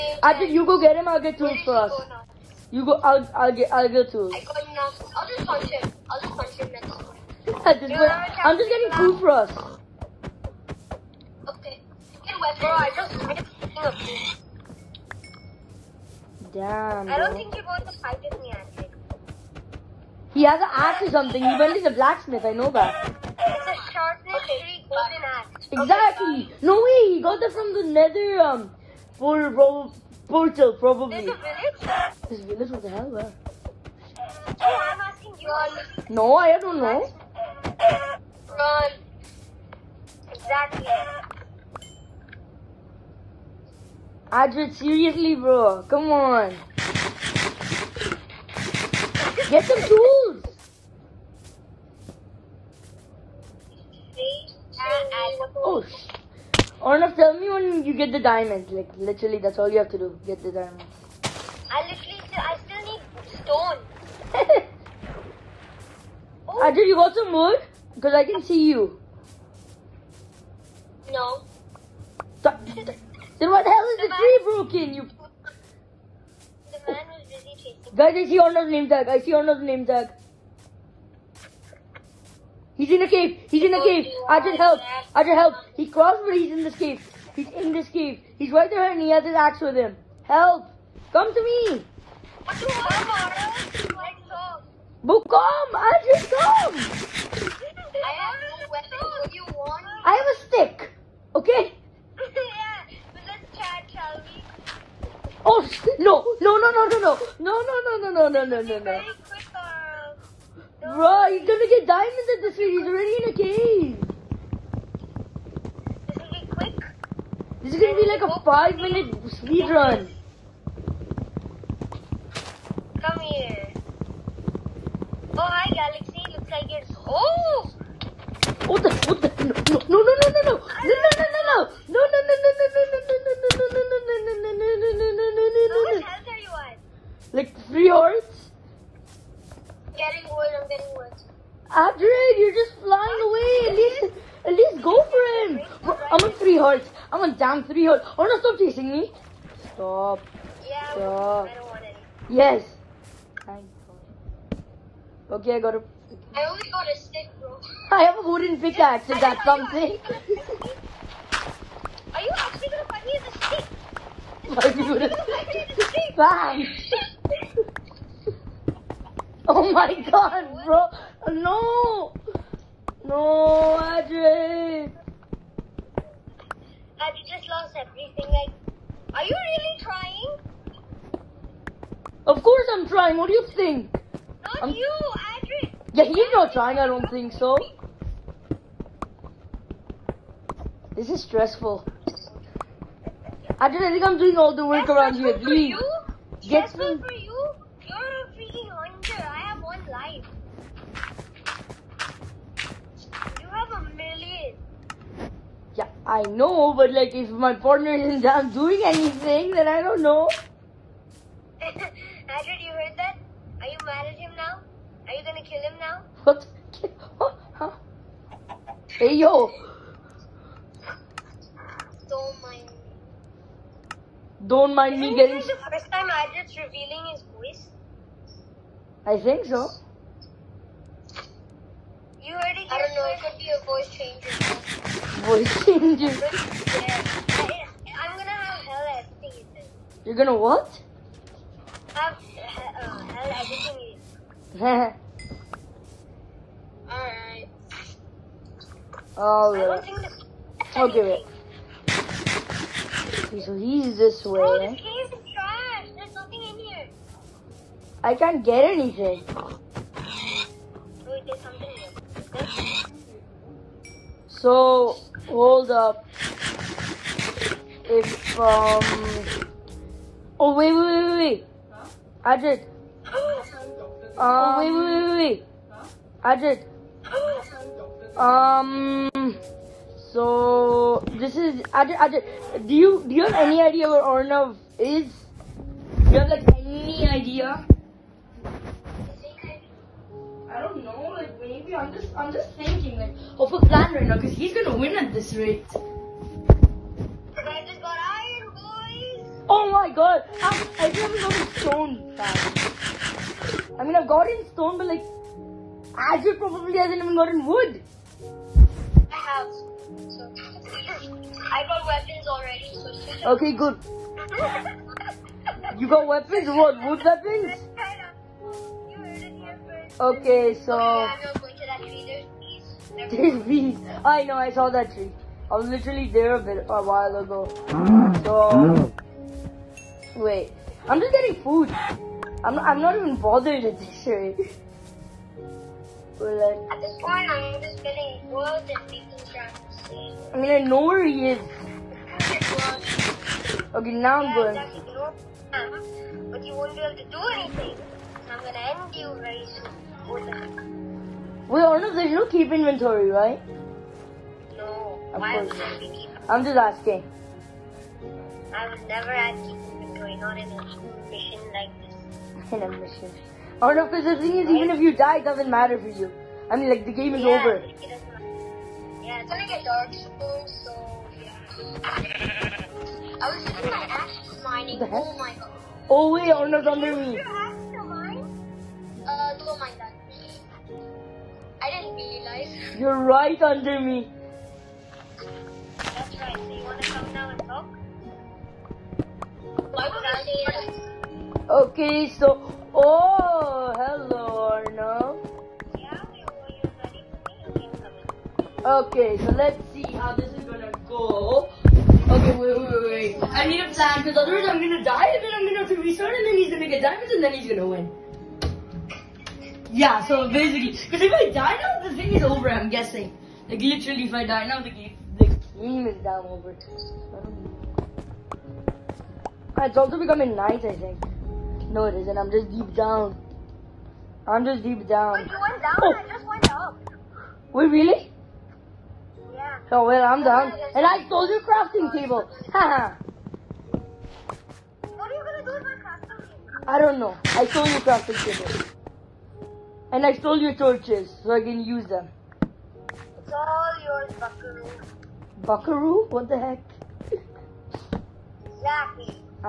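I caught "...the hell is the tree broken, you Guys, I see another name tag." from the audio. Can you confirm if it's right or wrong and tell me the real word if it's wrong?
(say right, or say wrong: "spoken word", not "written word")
right.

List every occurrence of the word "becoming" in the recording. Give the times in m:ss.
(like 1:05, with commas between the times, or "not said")
6:59.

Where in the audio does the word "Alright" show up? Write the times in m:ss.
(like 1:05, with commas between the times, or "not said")
4:04, 4:09.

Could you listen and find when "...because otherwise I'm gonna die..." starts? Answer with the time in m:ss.
6:43.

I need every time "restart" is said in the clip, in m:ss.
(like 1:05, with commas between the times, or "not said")
6:45.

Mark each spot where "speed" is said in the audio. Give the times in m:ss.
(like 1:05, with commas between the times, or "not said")
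1:52, 1:59.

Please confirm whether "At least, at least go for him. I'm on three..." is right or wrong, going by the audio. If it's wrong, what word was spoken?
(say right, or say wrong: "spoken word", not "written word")
right.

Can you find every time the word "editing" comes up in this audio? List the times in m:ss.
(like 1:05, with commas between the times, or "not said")
3:59, 4:03.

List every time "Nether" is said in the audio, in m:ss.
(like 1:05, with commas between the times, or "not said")
0:27.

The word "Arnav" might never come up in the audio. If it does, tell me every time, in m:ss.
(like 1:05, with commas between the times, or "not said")
0:56, 4:44.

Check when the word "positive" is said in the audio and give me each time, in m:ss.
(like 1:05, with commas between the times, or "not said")
not said.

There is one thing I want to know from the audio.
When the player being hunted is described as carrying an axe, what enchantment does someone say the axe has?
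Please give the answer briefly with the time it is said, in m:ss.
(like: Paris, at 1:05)
Sharpness, at 0:23.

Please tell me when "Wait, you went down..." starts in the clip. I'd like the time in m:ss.
7:05.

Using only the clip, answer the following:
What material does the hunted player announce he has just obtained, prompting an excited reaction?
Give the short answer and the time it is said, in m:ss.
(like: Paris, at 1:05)
Iron, at 4:58.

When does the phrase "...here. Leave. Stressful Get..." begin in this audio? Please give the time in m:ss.
3:15.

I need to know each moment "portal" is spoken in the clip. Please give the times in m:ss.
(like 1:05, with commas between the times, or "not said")
0:30.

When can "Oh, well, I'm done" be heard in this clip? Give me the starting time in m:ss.
7:09.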